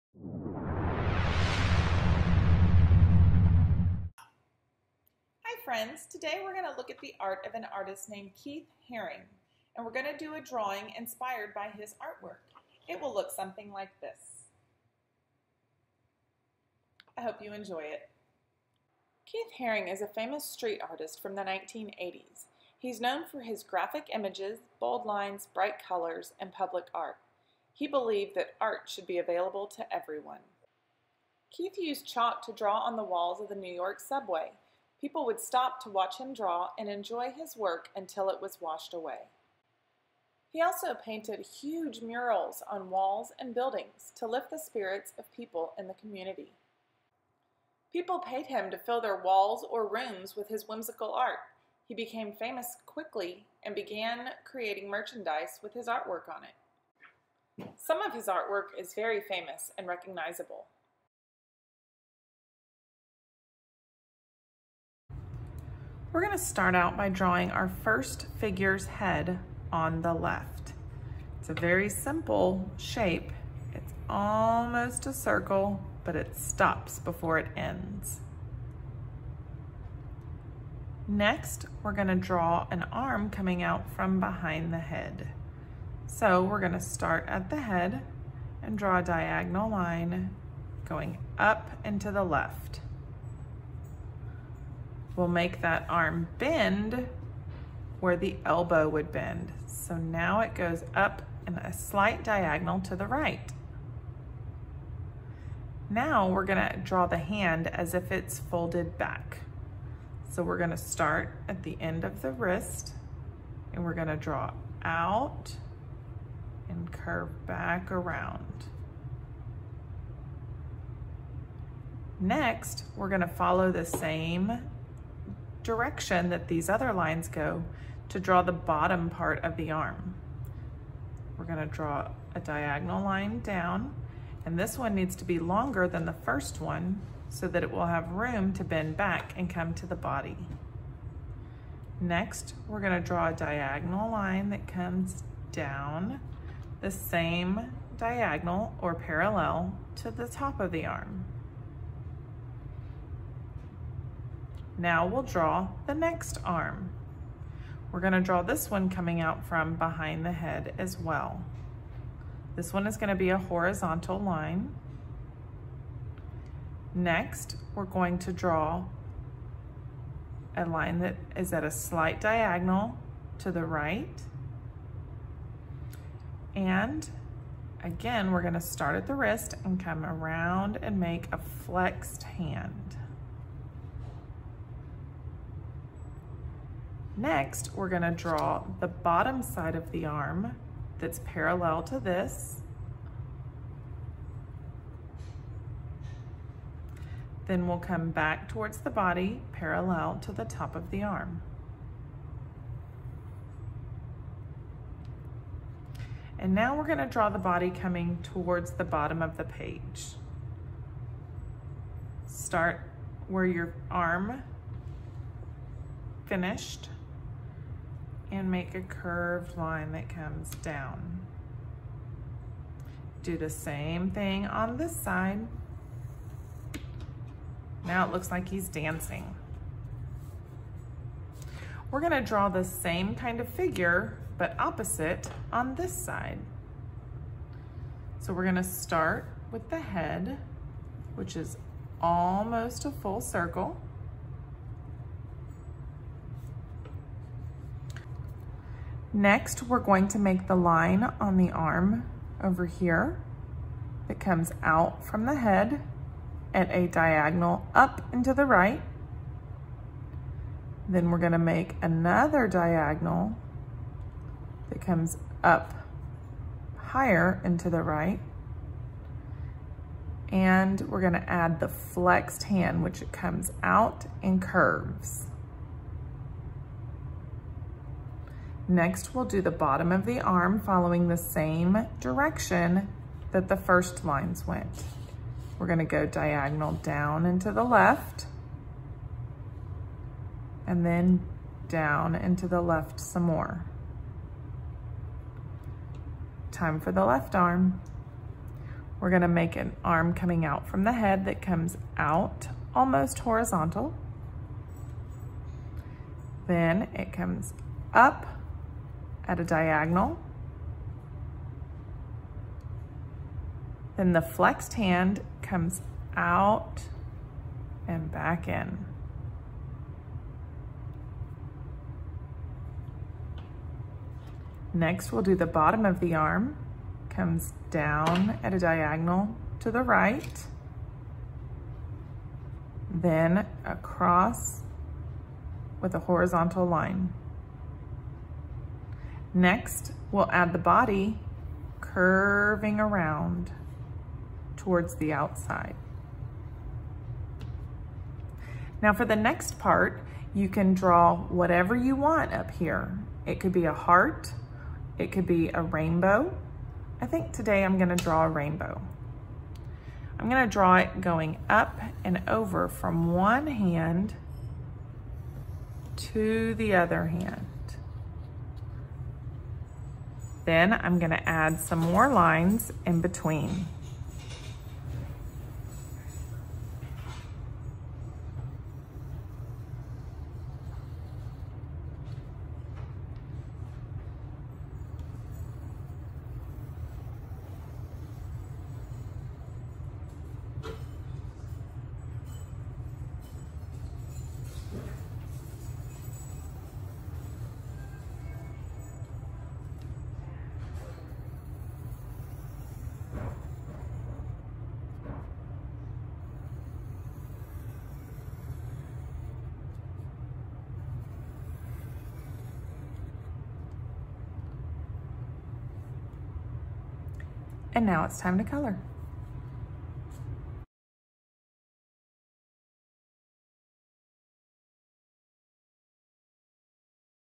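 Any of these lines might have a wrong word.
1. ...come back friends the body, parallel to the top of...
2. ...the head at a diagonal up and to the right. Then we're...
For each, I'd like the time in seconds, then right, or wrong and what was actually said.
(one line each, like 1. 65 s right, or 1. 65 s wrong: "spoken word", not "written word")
1. 197 s wrong: "towards", not "friends"
2. 255 s right.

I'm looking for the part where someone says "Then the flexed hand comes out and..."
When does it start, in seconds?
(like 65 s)
313 s.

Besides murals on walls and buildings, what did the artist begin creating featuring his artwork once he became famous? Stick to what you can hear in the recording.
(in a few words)
Merchandise.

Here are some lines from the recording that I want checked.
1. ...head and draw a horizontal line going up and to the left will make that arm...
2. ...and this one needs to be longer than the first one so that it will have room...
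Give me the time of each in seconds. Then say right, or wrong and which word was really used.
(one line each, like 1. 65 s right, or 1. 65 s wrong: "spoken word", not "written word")
1. 87 s wrong: "diagonal", not "horizontal"
2. 134 s right.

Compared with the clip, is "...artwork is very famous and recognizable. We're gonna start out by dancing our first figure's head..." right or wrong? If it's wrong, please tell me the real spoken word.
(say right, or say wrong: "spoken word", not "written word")
wrong: "drawing", not "dancing".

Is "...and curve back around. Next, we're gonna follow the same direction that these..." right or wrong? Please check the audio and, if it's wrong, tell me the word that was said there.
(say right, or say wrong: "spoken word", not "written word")
right.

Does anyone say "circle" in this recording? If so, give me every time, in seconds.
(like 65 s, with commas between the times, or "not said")
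75 s, 243 s.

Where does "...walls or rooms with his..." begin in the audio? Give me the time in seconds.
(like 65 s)
49 s.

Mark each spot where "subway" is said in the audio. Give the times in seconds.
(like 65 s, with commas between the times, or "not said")
34 s.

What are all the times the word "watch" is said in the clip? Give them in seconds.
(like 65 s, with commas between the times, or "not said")
35 s.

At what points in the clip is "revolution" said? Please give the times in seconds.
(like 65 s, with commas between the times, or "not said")
not said.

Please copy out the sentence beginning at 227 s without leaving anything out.
Now it looks like he's dancing.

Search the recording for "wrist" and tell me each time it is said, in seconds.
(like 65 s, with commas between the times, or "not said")
112 s, 179 s.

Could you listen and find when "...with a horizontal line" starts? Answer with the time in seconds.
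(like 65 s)
335 s.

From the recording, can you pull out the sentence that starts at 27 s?
He believed that art should be available to everyone.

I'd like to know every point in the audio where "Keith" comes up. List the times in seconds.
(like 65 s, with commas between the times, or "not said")
8 s, 19 s, 31 s.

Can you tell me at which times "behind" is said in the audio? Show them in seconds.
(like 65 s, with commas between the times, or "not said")
84 s, 159 s.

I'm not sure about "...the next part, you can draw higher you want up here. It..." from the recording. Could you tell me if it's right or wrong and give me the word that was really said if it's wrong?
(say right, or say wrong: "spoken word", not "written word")
wrong: "whatever", not "higher".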